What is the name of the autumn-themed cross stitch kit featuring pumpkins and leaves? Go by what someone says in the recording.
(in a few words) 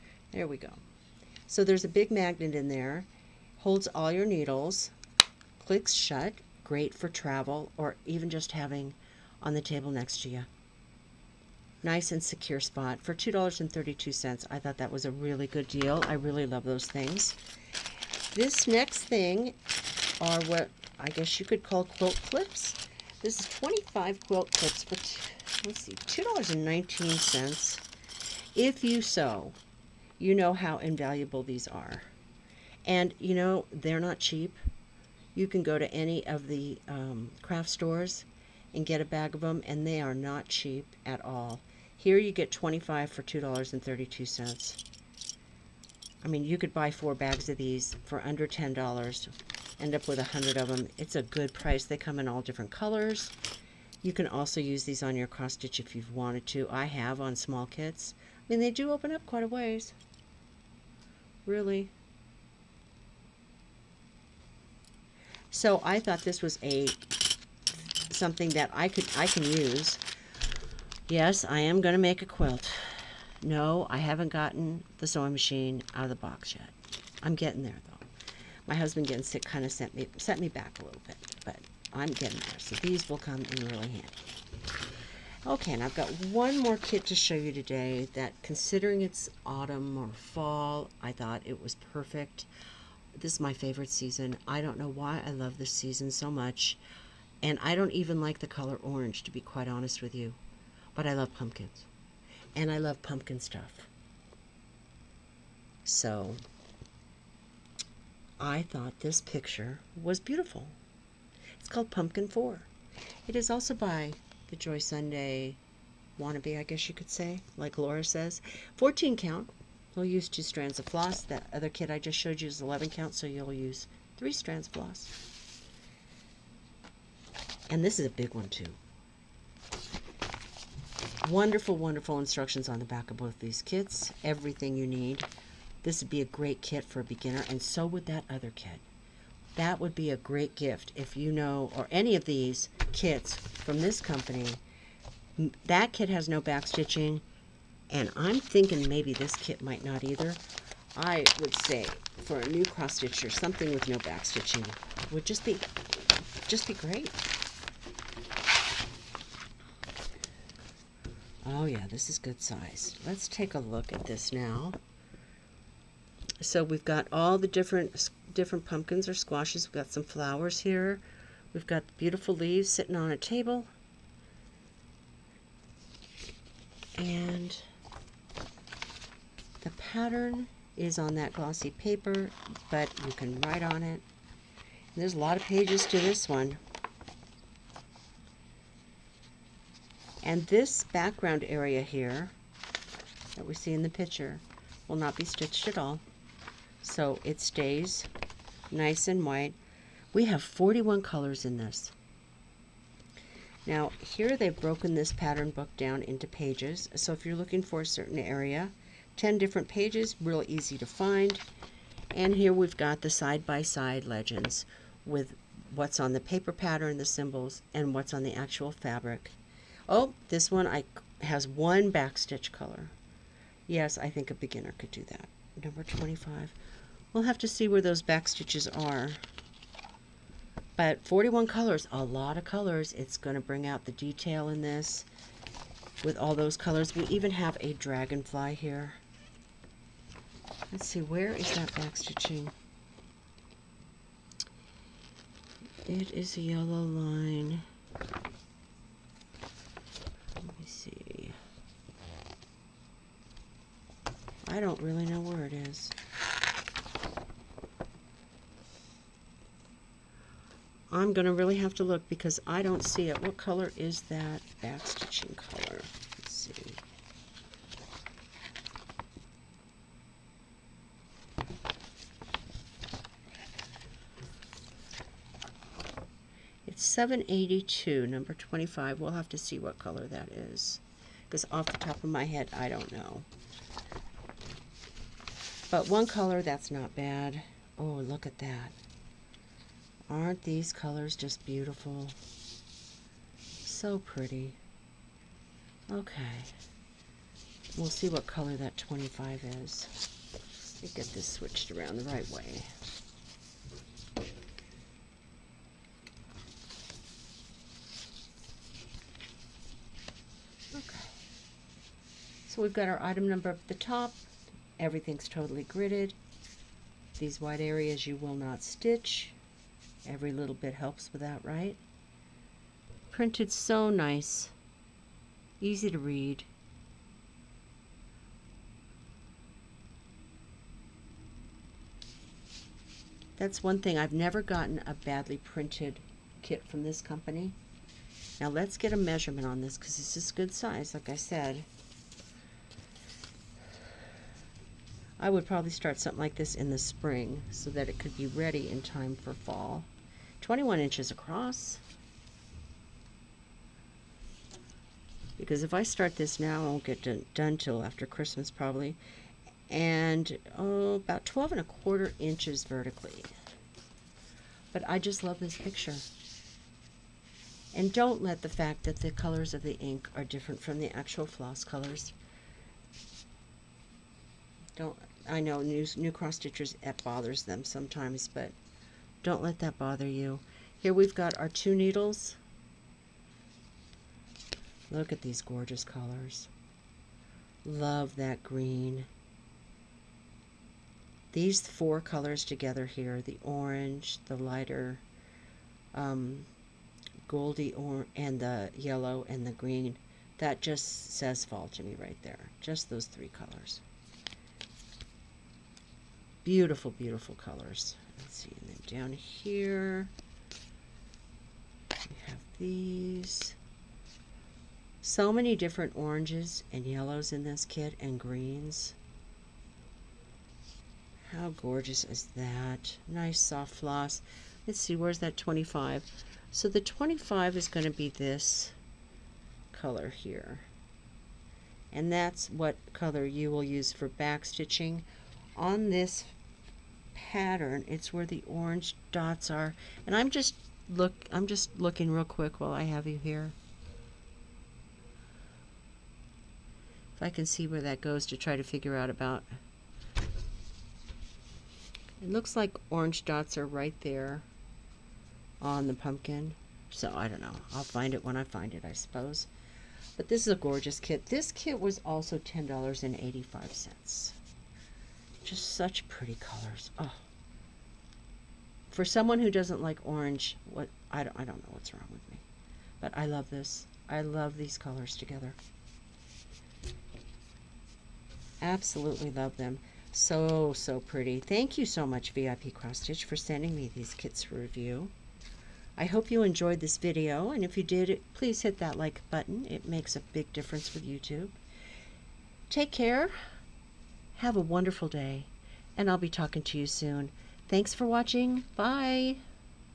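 Pumpkin 4.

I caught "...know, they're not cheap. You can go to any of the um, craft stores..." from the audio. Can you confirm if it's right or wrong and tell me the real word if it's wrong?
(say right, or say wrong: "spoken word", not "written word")
right.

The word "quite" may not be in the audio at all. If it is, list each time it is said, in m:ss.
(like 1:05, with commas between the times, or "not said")
0:59, 1:39.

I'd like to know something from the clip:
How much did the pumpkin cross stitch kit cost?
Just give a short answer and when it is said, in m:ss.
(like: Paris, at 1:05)
$10.85, at 7:42.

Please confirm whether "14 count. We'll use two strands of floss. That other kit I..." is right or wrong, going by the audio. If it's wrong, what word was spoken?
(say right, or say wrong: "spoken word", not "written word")
right.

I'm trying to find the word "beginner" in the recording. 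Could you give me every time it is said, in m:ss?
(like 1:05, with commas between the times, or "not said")
2:17, 3:44.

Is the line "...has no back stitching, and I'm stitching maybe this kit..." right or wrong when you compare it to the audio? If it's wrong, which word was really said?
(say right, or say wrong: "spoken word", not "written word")
wrong: "thinking", not "stitching".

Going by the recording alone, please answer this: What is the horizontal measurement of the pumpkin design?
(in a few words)
21 inches.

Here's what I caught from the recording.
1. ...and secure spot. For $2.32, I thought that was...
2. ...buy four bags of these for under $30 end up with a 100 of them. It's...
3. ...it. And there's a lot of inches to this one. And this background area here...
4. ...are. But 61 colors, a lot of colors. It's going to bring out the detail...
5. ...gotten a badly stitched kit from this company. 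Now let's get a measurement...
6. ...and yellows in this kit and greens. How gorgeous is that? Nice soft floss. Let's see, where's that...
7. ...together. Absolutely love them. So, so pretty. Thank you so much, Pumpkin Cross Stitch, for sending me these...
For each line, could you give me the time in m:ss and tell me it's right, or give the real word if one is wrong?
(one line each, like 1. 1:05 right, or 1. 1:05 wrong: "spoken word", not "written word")
1. 0:12 right
2. 0:46 wrong: "10", not "30"
3. 3:03 wrong: "pages", not "inches"
4. 3:48 wrong: "41", not "61"
5. 5:34 wrong: "printed", not "stitched"
6. 6:56 right
7. 7:55 wrong: "VIP", not "Pumpkin".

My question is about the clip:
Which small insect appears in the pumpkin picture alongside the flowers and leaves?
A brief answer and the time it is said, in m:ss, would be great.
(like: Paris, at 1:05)
dragonfly, at 3:57.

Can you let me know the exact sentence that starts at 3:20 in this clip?
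We have 41 colors in this.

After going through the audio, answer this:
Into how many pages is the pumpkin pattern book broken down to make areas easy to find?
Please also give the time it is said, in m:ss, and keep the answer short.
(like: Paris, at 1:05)
10, at 3:29.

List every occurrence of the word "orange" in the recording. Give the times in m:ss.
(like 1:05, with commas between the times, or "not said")
1:38, 6:33, 6:55, 7:18, 7:32, 7:50.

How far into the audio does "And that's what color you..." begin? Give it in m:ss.
7:11.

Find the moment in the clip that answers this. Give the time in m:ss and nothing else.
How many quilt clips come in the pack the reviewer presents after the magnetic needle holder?
0:23.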